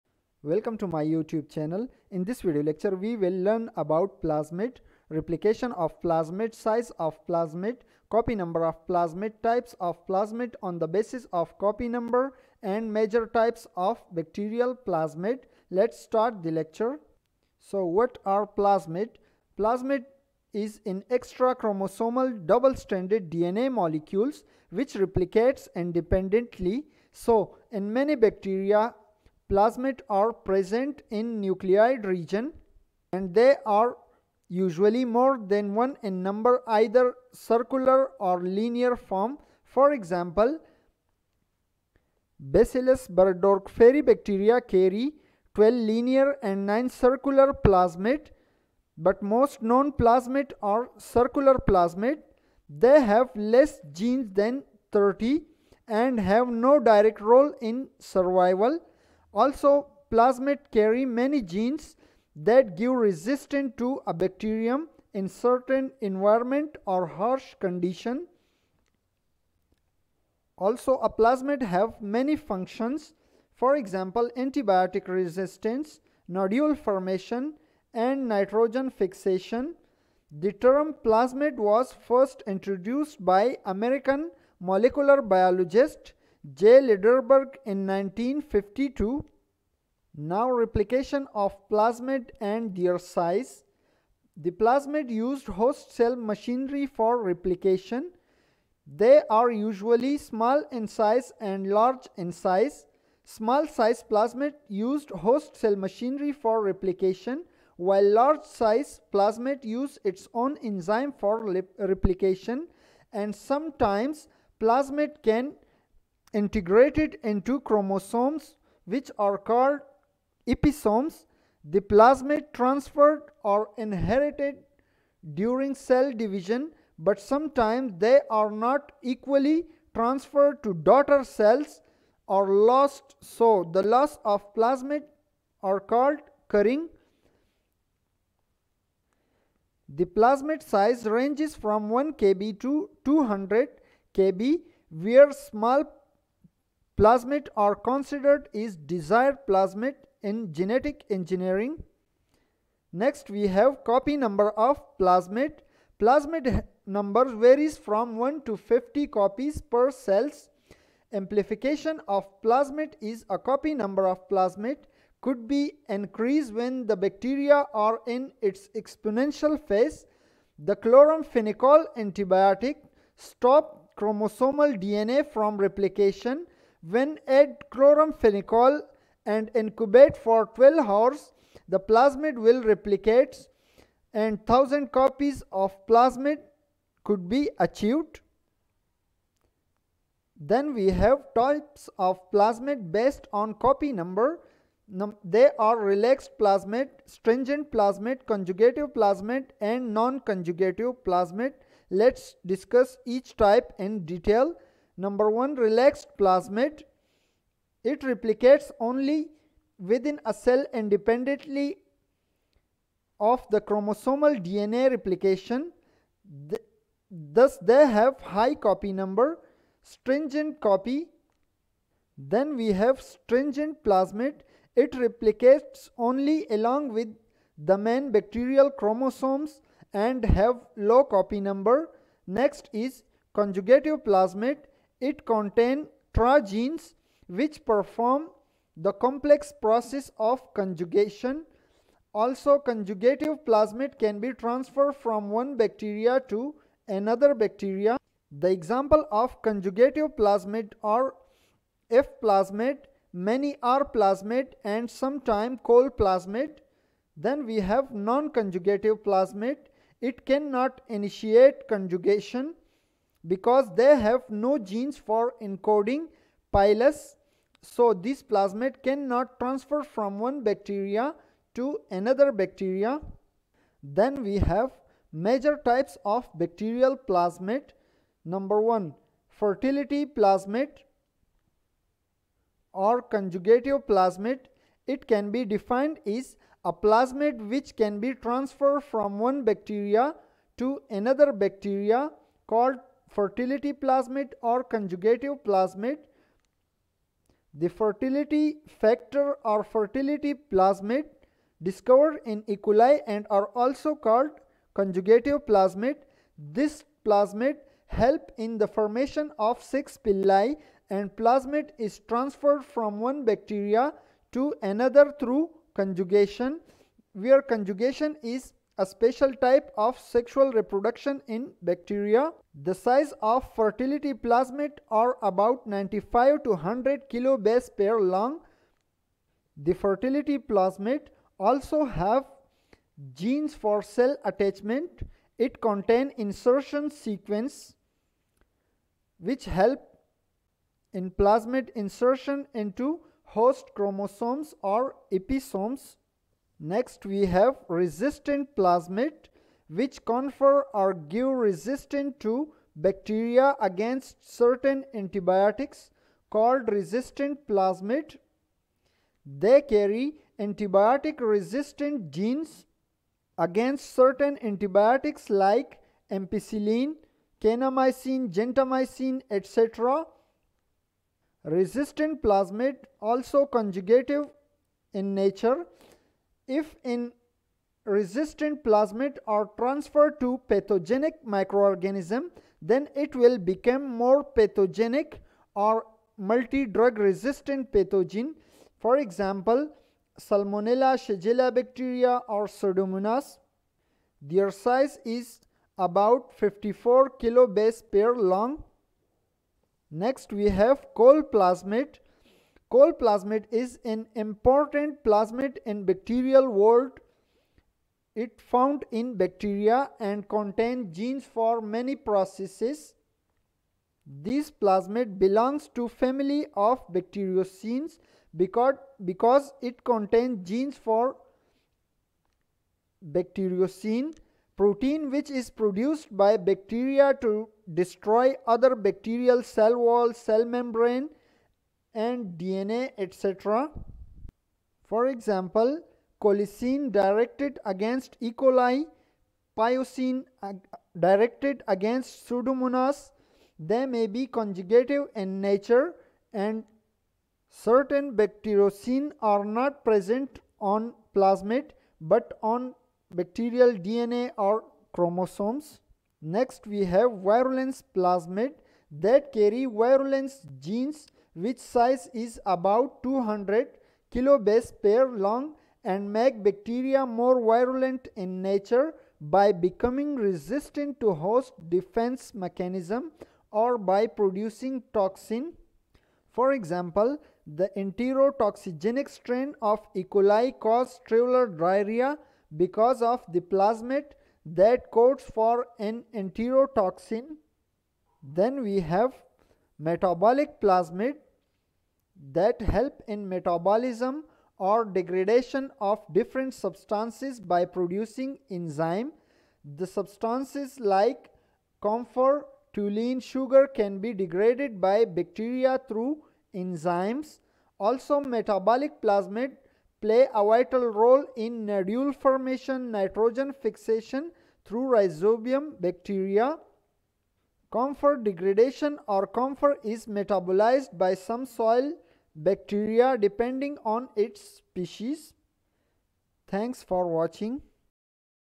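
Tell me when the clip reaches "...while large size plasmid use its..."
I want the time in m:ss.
1:47.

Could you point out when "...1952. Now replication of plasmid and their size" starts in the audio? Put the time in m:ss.
1:27.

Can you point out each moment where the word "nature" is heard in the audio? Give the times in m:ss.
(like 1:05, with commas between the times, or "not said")
6:15, 7:25, 7:48.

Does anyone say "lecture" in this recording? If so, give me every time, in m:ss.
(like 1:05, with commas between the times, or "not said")
0:02, 0:16.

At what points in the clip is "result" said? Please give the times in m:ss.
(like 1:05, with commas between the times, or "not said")
not said.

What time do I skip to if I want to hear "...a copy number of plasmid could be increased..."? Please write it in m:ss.
2:43.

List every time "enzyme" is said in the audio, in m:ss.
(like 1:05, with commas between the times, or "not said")
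1:50, 8:18, 8:26.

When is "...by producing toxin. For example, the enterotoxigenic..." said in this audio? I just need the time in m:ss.
7:53.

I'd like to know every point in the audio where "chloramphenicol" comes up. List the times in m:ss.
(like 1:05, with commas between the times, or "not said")
2:50, 2:57.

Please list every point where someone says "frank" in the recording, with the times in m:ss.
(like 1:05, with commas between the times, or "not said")
not said.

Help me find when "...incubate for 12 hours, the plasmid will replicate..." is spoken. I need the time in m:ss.
2:59.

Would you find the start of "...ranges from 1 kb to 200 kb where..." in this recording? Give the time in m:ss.
2:21.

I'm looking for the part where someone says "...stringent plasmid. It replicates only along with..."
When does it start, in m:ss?
3:43.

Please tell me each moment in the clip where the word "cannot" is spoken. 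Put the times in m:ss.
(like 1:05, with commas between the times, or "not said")
4:20, 4:28.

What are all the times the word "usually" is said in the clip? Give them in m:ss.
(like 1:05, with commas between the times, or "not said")
0:34, 1:39.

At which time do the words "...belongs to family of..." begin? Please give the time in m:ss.
6:55.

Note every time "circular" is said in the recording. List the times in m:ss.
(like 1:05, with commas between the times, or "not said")
0:37, 0:46, 0:50.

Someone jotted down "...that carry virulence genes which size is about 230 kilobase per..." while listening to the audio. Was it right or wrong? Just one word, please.
wrong.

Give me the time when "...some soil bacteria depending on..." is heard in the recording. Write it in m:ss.
8:41.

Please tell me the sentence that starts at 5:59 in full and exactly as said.
They carry antibiotic resistant genes against certain antibiotics like ampicillin, kanamycin, gentamicin, etc.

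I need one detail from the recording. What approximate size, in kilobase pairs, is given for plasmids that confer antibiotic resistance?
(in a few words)
54 kilobase pairs.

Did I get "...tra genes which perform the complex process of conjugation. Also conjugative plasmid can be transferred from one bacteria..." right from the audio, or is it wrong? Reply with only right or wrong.
right.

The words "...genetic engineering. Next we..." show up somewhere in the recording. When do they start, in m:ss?
2:30.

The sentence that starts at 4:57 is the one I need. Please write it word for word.
The fertility factor or fertility plasmid discovered in E.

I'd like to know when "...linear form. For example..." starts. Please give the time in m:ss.
0:38.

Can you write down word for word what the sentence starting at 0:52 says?
They have less genes than 30 and have no direct role in survival.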